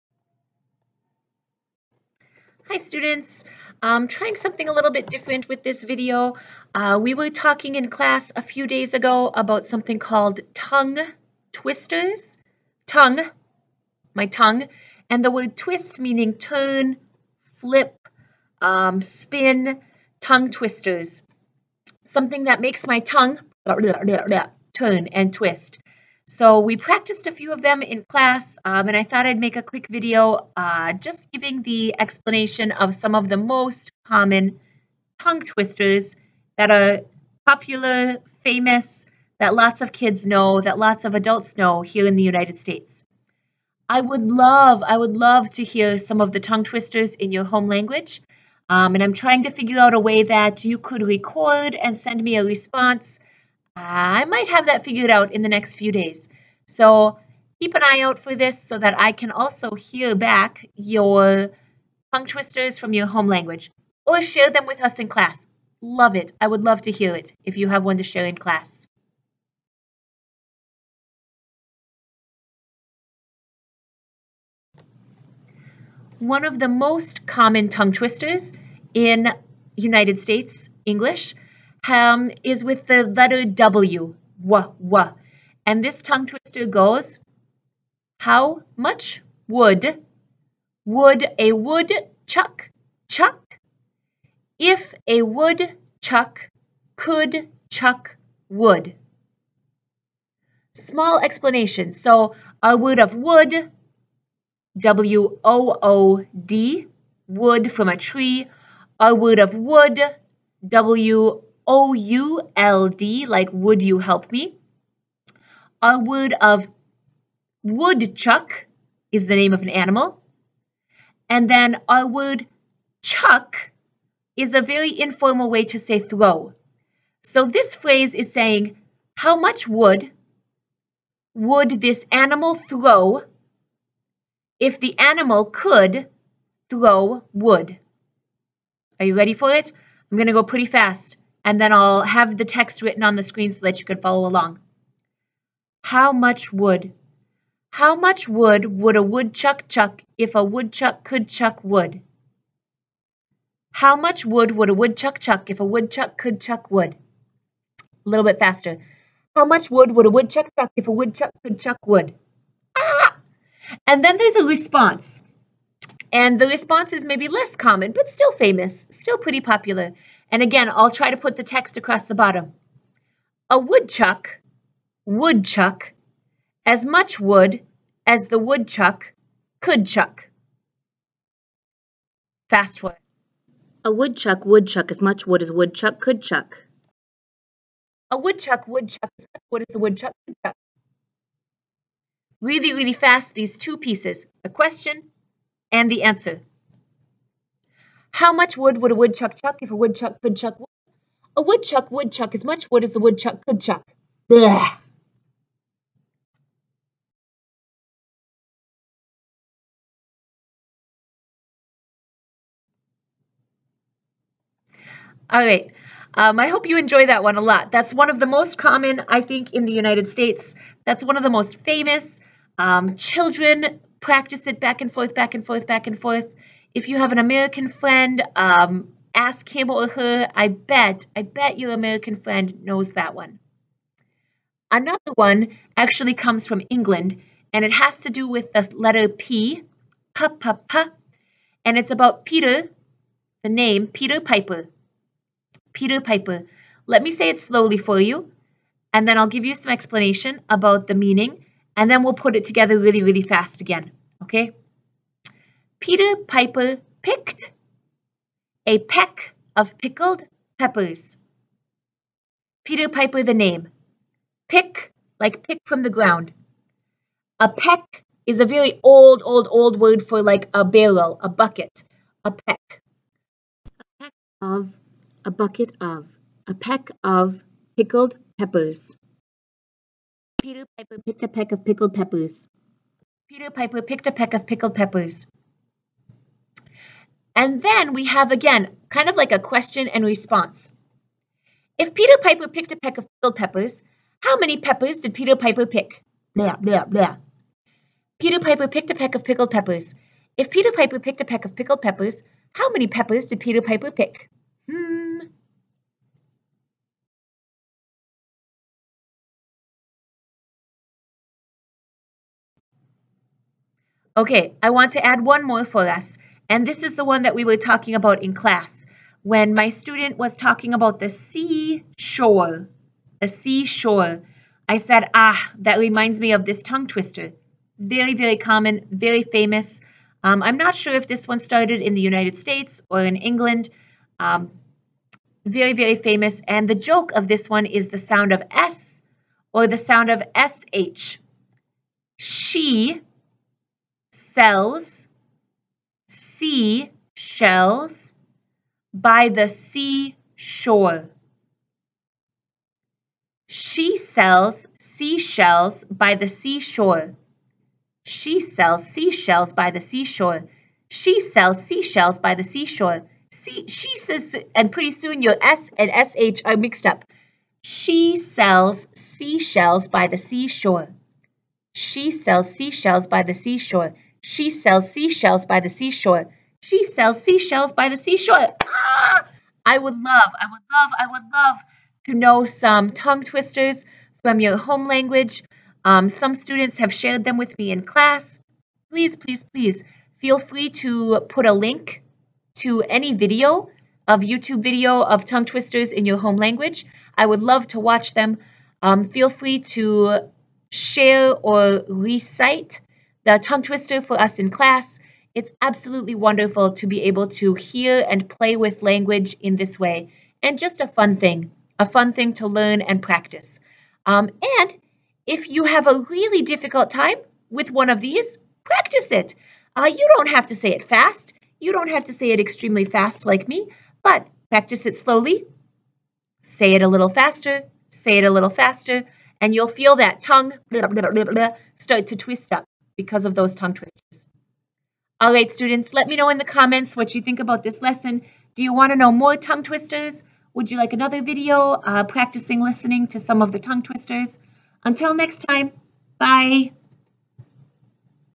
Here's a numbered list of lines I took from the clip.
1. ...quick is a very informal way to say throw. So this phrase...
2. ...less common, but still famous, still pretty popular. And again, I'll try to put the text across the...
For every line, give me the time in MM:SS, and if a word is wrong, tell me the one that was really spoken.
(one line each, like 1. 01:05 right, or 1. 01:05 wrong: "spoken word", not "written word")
1. 02:03 wrong: "chuck", not "quick"
2. 02:47 right.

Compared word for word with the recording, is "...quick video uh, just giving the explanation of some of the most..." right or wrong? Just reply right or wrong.
right.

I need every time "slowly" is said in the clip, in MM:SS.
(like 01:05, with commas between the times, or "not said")
04:07, 07:04.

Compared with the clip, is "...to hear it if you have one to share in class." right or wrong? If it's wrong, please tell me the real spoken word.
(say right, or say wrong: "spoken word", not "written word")
right.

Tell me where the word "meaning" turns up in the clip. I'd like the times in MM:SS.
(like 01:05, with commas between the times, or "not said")
00:15, 04:10.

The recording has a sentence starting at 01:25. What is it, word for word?
And this tongue twister goes, how much would, would a woodchuck chuck?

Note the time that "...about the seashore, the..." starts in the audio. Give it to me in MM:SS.
05:20.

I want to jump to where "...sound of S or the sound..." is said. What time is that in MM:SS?
05:37.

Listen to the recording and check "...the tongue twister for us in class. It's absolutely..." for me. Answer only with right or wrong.
right.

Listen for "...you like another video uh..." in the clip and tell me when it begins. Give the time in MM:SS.
07:20.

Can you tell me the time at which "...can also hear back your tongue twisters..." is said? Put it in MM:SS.
00:59.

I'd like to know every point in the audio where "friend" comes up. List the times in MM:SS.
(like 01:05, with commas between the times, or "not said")
03:47, 03:52.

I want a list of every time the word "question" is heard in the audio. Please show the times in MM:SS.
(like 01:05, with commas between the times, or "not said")
03:14, 04:49.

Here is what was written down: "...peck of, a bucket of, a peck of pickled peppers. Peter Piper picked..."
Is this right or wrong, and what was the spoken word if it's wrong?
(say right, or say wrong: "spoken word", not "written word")
right.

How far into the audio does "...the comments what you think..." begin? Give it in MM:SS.
07:16.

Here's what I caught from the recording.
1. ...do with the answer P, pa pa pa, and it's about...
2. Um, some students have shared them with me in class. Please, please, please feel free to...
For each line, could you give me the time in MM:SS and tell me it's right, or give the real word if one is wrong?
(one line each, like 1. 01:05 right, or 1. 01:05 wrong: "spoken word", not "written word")
1. 03:58 wrong: "letter", not "answer"
2. 06:25 right.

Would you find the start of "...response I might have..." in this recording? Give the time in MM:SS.
00:52.